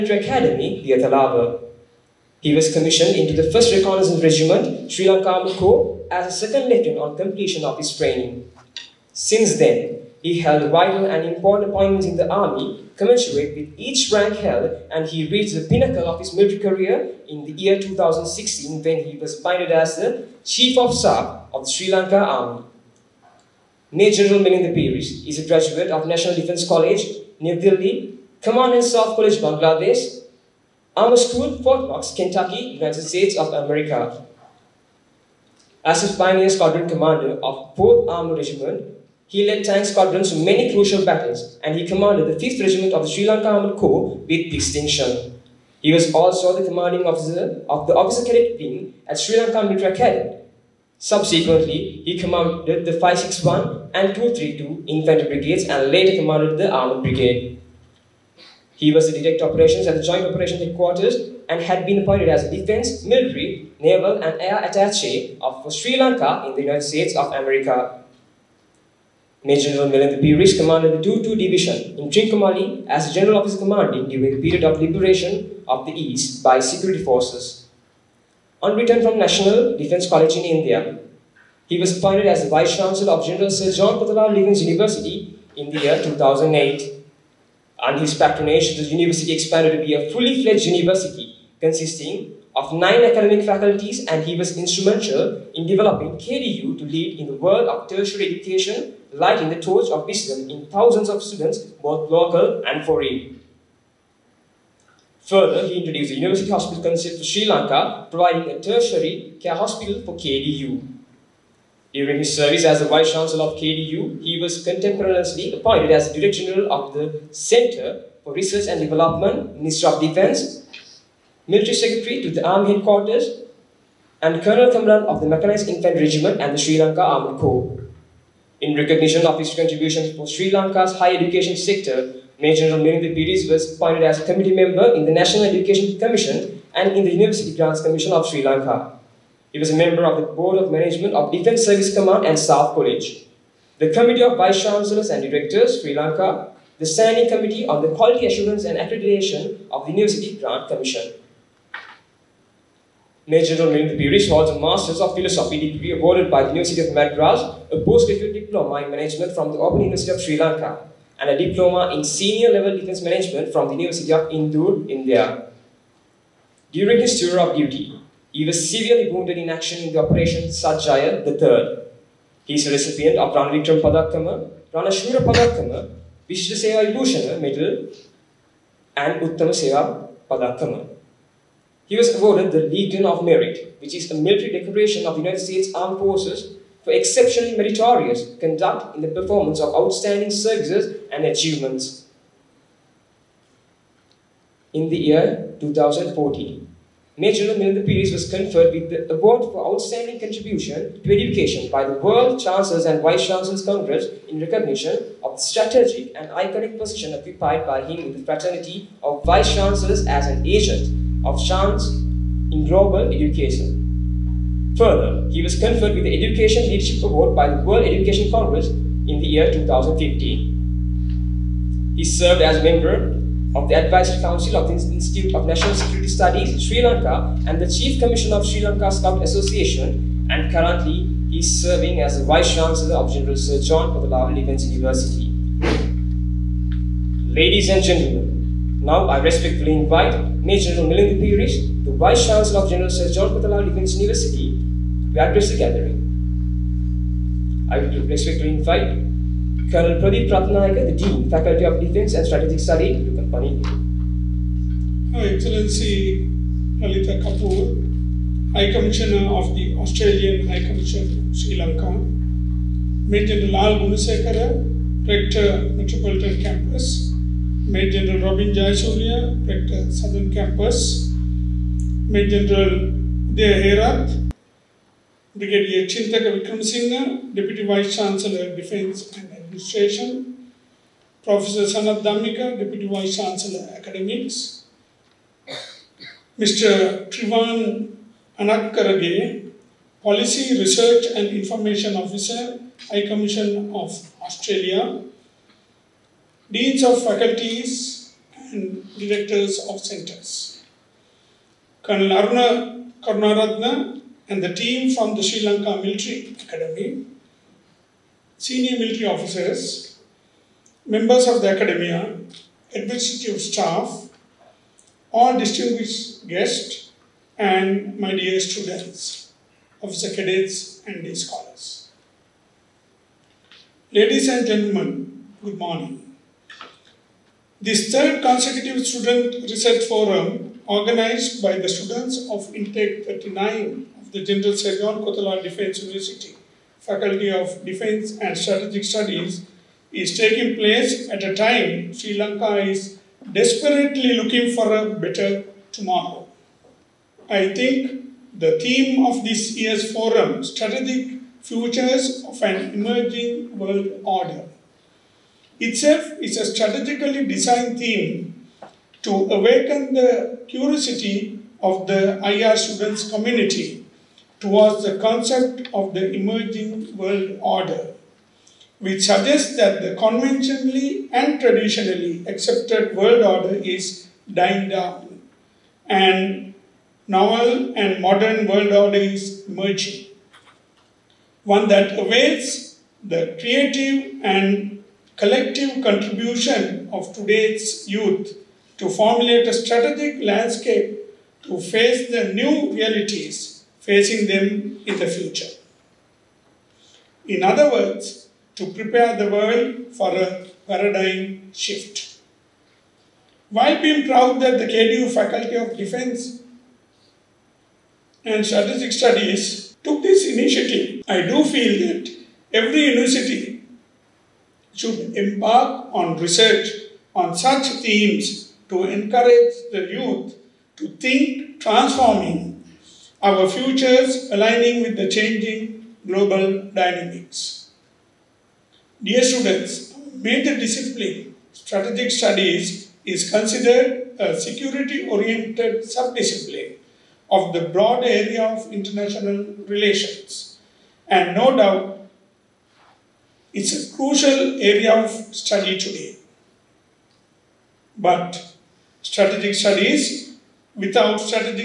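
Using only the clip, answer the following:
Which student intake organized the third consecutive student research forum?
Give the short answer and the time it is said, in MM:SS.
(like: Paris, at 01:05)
Intake 39, at 05:32.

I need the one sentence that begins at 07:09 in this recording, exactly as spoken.
Dear students, major discipline, strategic studies, is considered a security-oriented sub-discipline of the broad area of international relations.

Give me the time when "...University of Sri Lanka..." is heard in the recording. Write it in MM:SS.
02:39.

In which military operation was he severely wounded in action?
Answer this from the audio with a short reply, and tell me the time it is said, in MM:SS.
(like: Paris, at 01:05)
Operation Sath Jaya III, at 02:49.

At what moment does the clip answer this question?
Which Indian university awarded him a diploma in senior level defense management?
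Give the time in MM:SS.
02:43.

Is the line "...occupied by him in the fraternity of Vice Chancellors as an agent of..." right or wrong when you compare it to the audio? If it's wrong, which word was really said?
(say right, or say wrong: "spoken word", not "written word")
right.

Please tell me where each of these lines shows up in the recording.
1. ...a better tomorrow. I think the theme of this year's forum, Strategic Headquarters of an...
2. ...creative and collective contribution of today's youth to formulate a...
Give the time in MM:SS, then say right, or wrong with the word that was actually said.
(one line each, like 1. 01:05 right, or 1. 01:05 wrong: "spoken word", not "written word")
1. 05:44 wrong: "Futures", not "Headquarters"
2. 06:23 right.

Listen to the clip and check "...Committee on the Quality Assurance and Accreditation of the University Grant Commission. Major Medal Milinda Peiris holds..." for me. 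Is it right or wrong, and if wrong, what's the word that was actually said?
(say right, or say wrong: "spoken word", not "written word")
wrong: "General", not "Medal".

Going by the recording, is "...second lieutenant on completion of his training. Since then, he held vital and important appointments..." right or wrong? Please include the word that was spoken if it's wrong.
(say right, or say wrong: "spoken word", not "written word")
right.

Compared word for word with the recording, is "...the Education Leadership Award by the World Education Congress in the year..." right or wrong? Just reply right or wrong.
right.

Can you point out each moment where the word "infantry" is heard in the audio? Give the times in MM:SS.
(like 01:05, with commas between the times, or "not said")
00:54, 02:05.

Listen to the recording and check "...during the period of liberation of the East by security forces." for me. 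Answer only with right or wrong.
right.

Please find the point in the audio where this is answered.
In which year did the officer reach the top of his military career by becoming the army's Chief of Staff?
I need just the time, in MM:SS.
00:17.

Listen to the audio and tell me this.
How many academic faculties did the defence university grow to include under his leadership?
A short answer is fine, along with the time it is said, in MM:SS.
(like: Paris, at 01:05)
nine, at 01:32.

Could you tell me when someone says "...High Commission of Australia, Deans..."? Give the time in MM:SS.
04:52.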